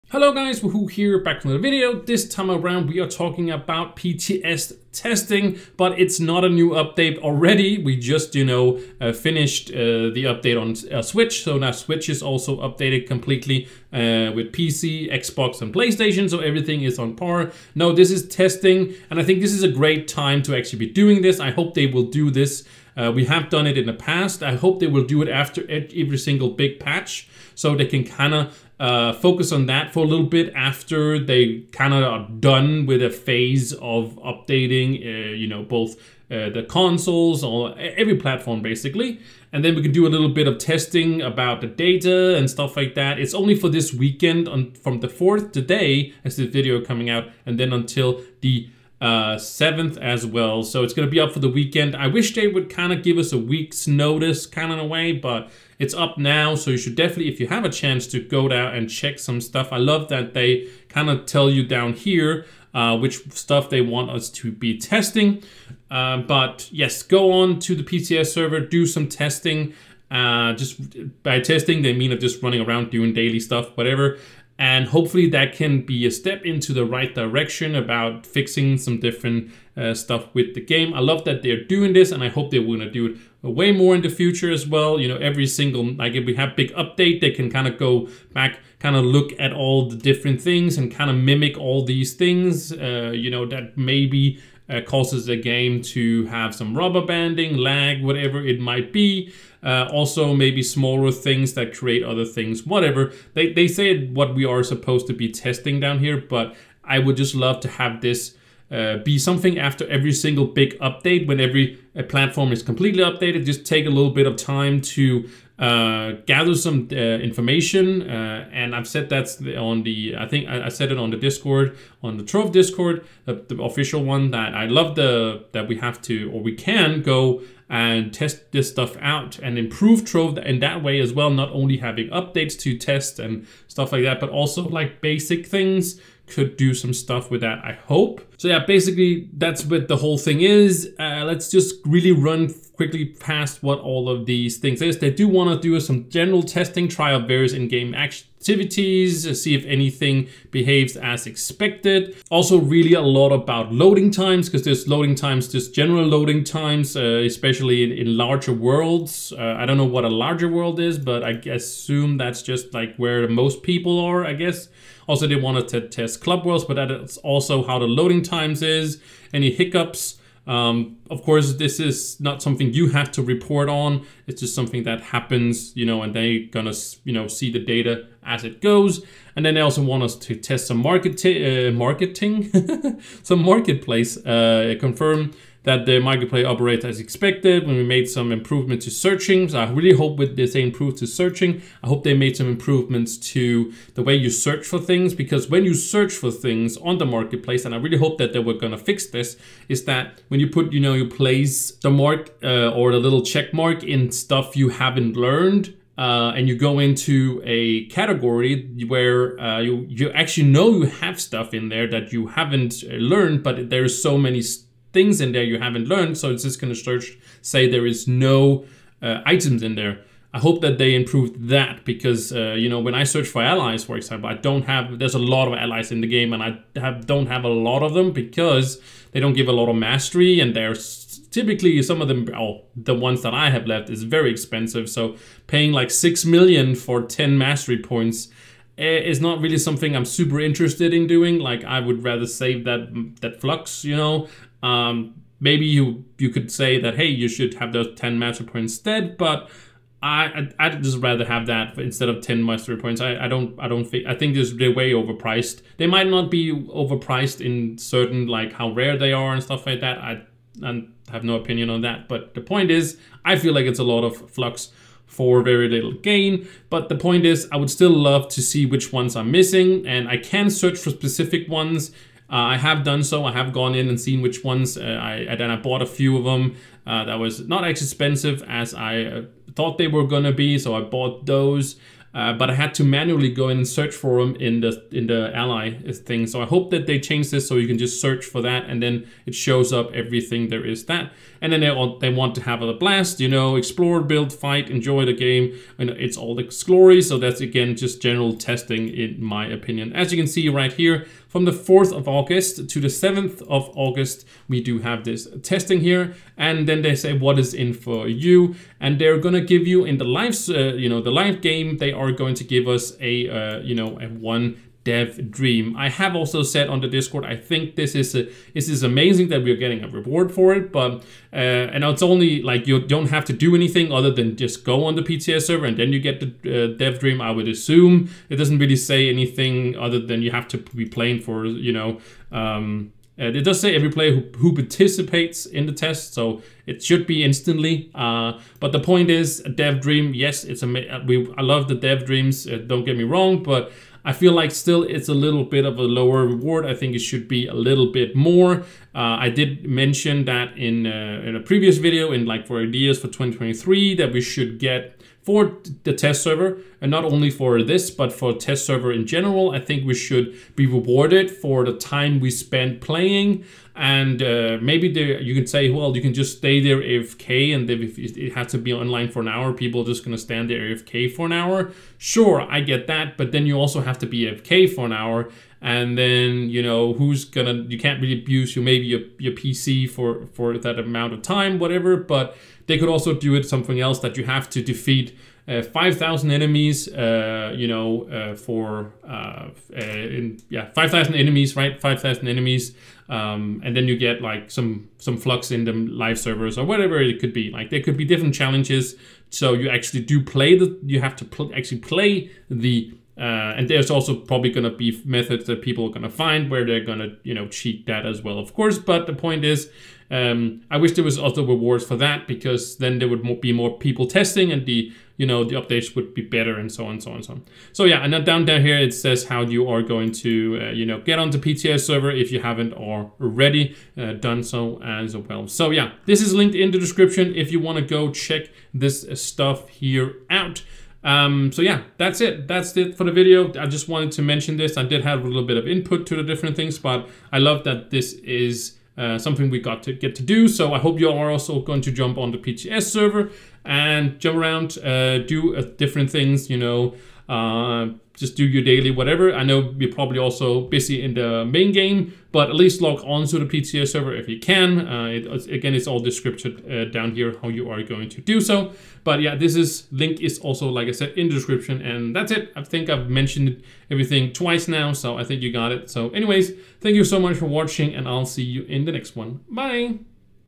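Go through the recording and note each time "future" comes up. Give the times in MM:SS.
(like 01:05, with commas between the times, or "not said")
01:24.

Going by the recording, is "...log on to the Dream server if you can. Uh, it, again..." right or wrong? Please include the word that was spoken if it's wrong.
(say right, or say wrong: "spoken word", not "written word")
wrong: "PTS", not "Dream".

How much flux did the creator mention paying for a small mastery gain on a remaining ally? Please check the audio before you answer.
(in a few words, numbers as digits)
6 million.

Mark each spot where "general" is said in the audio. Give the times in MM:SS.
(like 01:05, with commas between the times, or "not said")
02:26, 02:35, 04:58, 05:59.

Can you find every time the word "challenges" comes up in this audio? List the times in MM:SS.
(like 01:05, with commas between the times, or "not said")
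06:38.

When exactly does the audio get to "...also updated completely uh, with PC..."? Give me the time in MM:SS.
00:12.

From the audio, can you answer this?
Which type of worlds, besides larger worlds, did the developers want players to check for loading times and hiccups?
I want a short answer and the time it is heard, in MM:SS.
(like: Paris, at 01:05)
Club worlds, at 02:46.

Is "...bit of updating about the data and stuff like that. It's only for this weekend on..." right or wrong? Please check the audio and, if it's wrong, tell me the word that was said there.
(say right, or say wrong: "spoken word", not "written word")
wrong: "testing", not "updating".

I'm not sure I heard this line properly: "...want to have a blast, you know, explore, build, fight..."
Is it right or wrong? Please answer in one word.
right.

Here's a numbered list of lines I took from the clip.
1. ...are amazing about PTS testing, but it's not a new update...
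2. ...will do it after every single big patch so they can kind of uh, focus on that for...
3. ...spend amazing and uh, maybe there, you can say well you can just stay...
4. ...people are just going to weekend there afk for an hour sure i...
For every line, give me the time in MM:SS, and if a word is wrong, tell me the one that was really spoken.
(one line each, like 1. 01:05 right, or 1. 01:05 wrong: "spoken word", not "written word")
1. 00:02 wrong: "talking", not "amazing"
2. 00:24 right
3. 06:02 wrong: "playing", not "amazing"
4. 06:09 wrong: "stand", not "weekend".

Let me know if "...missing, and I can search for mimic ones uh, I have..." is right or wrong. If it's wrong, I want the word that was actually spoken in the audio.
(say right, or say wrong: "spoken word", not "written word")
wrong: "specific", not "mimic".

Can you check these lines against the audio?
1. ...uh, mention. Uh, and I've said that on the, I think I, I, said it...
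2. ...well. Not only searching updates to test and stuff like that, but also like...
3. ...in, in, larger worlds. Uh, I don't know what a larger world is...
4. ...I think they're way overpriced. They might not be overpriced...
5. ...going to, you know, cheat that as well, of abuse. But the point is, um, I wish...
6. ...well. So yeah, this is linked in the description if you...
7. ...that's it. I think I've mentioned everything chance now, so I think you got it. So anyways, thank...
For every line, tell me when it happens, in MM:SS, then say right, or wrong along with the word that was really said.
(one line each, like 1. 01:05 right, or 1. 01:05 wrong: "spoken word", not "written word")
1. 01:56 wrong: "information", not "mention"
2. 02:11 wrong: "having", not "searching"
3. 02:37 right
4. 04:14 right
5. 06:46 wrong: "course", not "abuse"
6. 07:05 right
7. 07:42 wrong: "twice", not "chance".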